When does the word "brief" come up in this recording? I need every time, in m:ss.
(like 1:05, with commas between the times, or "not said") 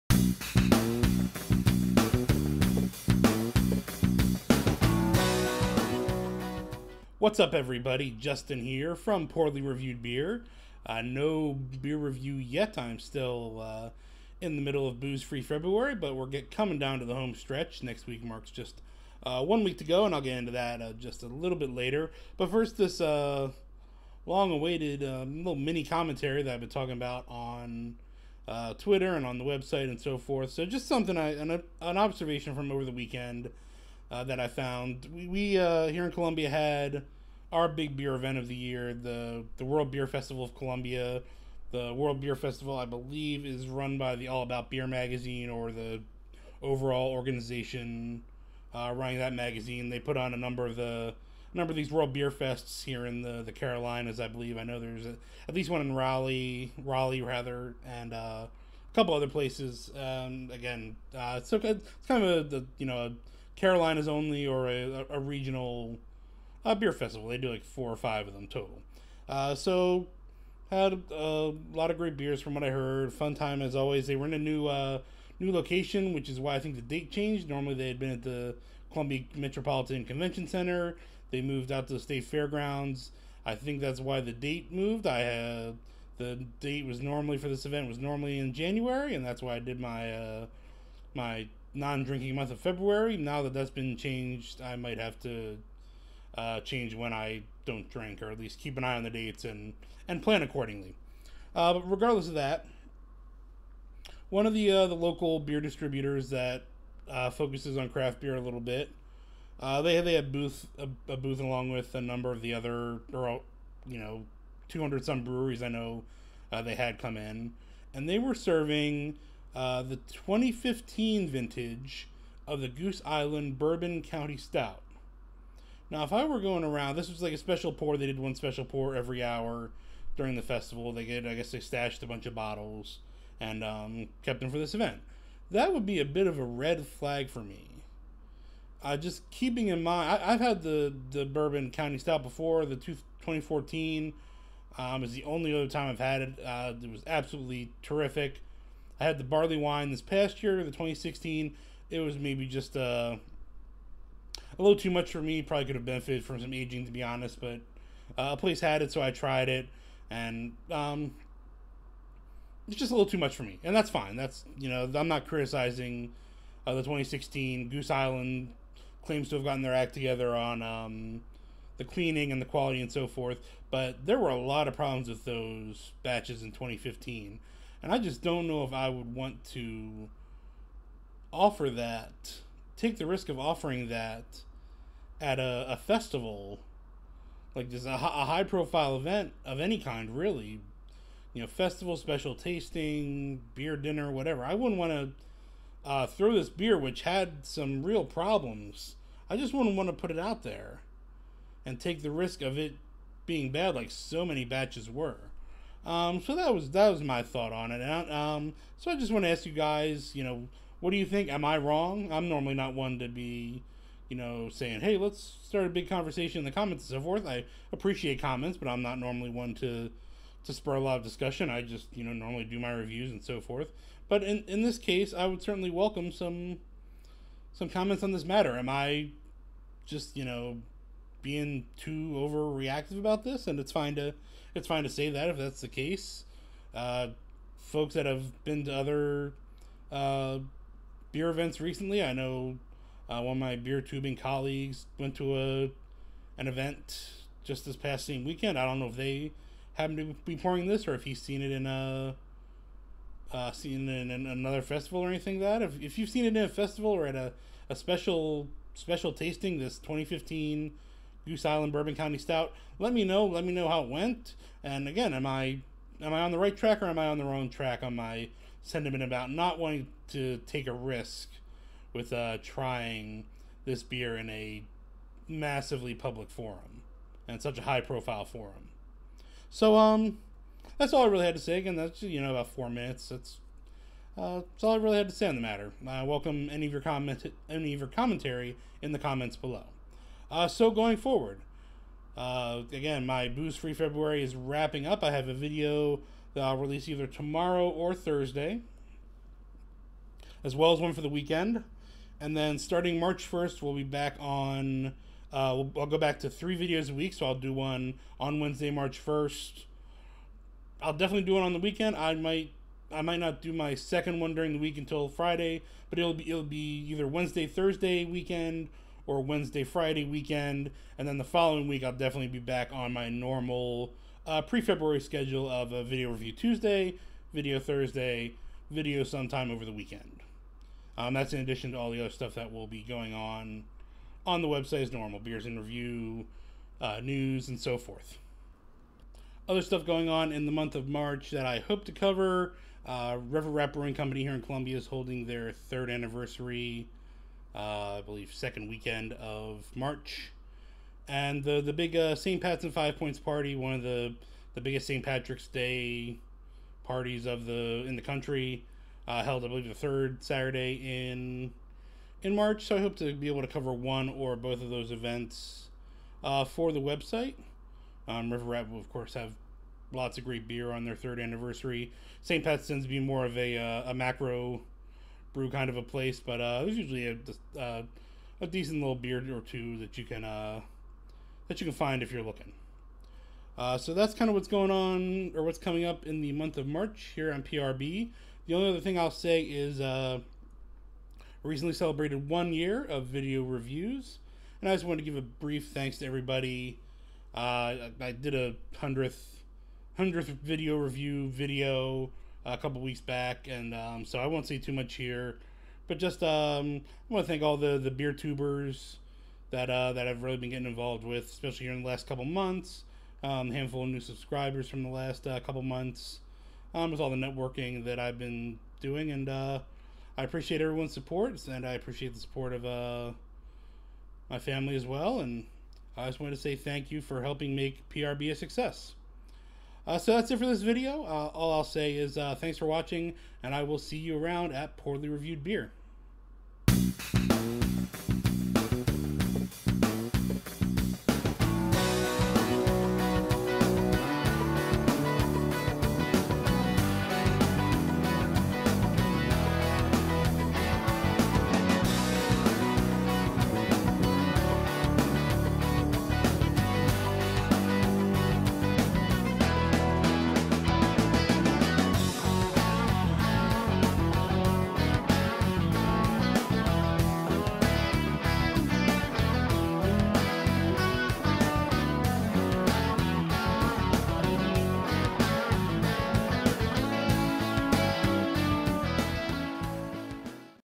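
6:35.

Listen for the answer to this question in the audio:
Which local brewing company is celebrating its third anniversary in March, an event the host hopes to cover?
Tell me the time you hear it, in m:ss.
5:43.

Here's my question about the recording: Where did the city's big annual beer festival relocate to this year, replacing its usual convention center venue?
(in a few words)
state fairgrounds.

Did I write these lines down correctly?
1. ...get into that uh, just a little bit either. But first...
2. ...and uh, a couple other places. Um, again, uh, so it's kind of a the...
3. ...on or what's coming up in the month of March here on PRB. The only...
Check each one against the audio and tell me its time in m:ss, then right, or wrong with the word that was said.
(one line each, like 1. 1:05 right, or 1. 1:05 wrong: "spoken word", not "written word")
1. 0:20 wrong: "later", not "either"
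2. 0:57 right
3. 6:24 right.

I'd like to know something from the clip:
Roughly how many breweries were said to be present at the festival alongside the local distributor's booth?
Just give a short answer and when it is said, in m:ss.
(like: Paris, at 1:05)
200, at 1:54.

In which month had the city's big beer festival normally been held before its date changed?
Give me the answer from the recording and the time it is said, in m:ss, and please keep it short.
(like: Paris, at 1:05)
January, at 1:28.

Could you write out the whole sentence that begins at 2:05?
Now, if I were going around, this was like a special pour.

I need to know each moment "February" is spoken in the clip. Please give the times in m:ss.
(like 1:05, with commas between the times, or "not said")
0:15, 1:32, 4:53, 5:24.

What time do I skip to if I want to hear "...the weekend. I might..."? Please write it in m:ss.
5:11.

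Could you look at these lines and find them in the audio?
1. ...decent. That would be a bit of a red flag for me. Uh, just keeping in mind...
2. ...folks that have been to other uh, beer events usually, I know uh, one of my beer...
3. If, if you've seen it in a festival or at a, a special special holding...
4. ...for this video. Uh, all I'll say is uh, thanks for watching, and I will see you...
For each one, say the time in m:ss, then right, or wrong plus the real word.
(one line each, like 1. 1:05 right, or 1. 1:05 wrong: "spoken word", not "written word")
1. 2:14 wrong: "event", not "decent"
2. 3:57 wrong: "recently", not "usually"
3. 4:15 wrong: "tasting", not "holding"
4. 7:10 right.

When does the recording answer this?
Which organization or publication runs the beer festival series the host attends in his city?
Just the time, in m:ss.
0:44.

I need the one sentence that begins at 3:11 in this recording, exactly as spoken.
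You know, festival, special tasting, beer dinner, whatever.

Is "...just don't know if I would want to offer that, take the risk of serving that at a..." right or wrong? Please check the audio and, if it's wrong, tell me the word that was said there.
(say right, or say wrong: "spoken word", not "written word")
wrong: "offering", not "serving".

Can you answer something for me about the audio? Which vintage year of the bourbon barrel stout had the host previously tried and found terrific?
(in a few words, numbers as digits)
2014.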